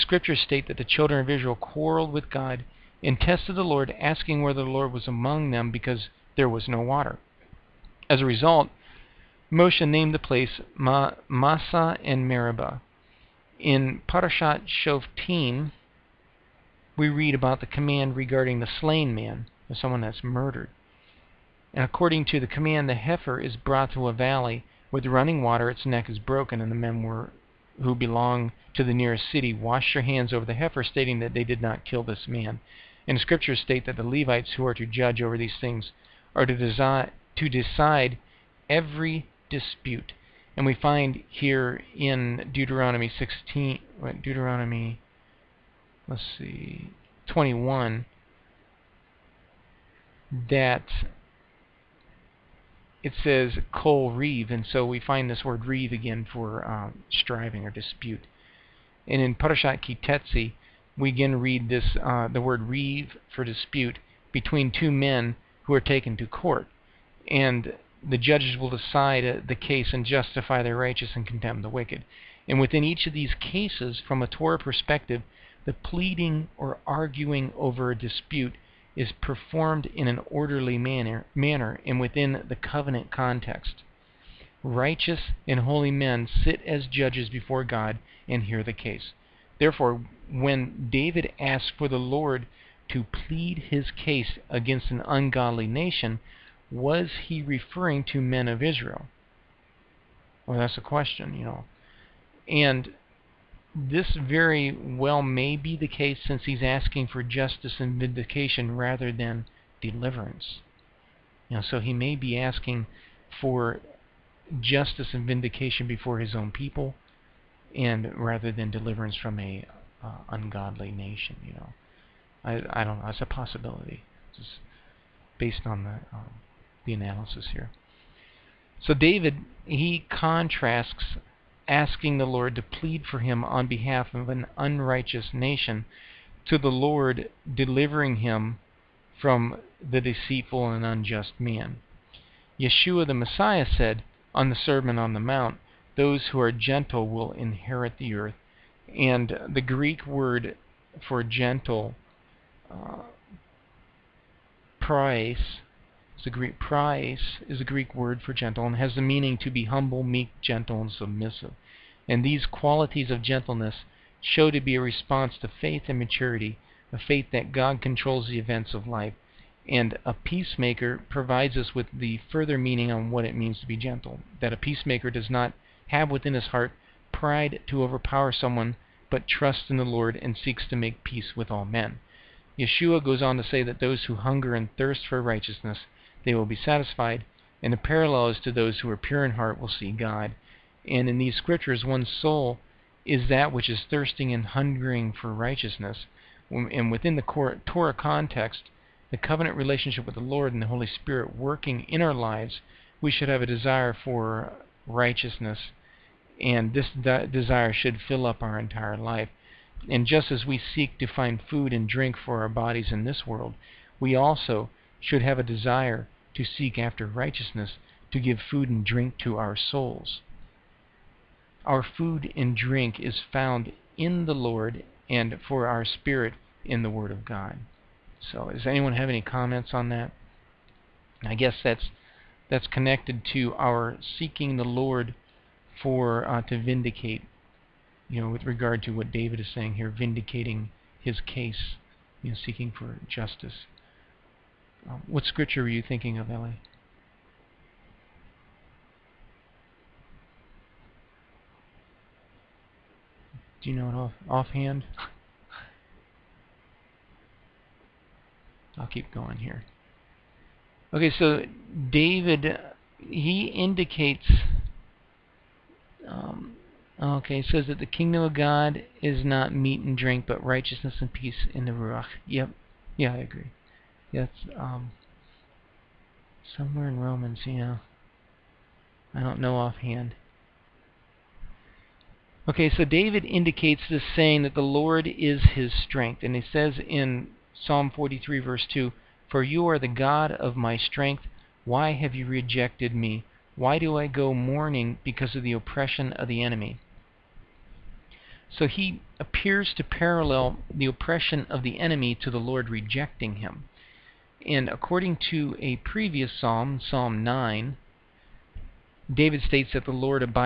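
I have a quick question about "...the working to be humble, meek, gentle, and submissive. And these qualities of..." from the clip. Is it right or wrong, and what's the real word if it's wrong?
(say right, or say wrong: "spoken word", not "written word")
wrong: "meaning", not "working".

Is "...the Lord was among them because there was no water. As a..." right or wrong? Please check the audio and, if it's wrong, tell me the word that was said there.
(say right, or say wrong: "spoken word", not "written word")
right.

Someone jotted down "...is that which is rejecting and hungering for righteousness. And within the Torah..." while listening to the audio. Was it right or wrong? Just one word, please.
wrong.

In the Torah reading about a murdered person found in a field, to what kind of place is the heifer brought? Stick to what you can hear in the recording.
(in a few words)
a valley with running water.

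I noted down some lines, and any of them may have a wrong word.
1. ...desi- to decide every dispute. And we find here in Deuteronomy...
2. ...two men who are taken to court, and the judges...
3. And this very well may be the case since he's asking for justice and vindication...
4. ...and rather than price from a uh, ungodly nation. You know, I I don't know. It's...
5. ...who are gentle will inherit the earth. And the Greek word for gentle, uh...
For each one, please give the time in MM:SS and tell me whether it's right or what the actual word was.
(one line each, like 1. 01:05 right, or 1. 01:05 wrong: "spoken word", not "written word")
1. 00:36 right
2. 01:04 right
3. 01:42 right
4. 01:57 wrong: "deliverance", not "price"
5. 02:26 right.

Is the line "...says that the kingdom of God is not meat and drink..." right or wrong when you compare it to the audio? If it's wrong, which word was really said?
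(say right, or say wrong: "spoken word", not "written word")
right.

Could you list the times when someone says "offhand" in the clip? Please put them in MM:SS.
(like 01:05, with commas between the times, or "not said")
04:14, 04:39.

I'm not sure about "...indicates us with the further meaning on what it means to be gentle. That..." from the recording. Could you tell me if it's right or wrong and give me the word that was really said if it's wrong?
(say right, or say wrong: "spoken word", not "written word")
wrong: "provides", not "indicates".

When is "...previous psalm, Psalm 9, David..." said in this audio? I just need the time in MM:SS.
05:05.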